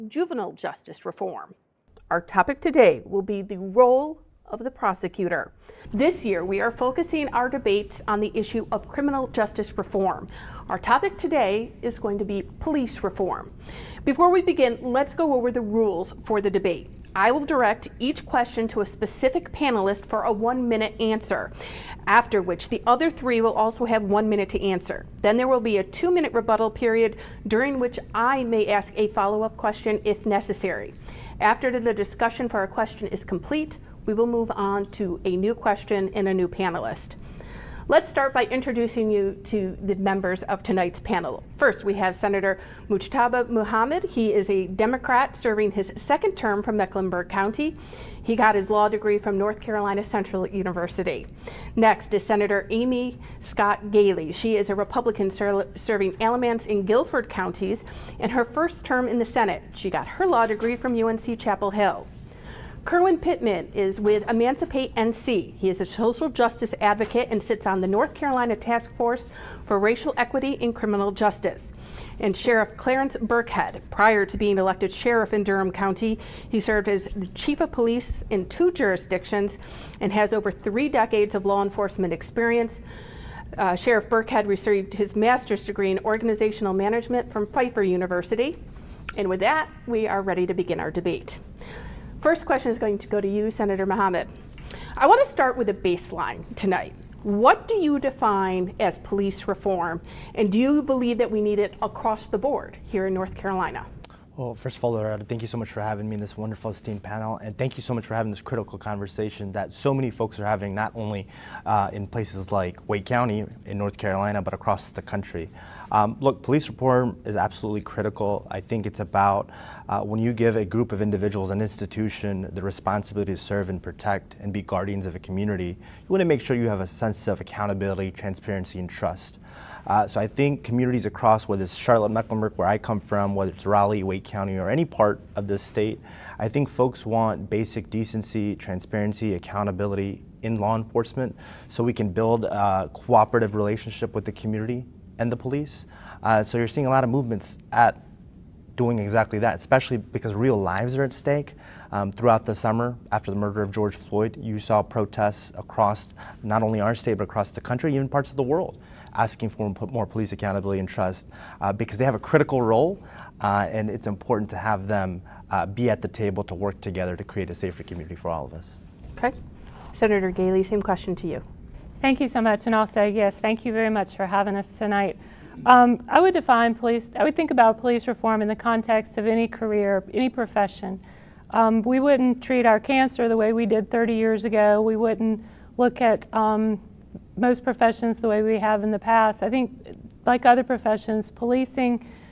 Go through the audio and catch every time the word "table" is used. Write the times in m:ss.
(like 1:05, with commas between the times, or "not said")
2:46.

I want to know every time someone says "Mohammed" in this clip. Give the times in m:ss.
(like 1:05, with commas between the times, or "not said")
0:43, 1:33.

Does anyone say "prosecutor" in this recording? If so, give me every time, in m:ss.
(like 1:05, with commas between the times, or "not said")
0:04.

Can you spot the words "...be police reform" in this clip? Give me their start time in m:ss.
0:12.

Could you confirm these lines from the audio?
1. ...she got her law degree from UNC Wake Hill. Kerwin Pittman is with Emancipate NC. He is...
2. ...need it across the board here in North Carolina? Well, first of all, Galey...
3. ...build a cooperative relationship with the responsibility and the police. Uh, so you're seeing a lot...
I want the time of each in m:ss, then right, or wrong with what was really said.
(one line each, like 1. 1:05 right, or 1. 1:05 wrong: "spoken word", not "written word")
1. 0:59 wrong: "Chapel", not "Wake"
2. 1:41 wrong: "Loretta", not "Galey"
3. 2:22 wrong: "community", not "responsibility".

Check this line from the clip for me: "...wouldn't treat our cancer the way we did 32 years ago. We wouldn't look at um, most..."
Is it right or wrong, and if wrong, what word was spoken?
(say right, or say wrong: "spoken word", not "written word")
wrong: "30", not "32".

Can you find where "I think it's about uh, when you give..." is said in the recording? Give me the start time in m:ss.
1:58.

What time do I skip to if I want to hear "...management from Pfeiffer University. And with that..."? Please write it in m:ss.
1:26.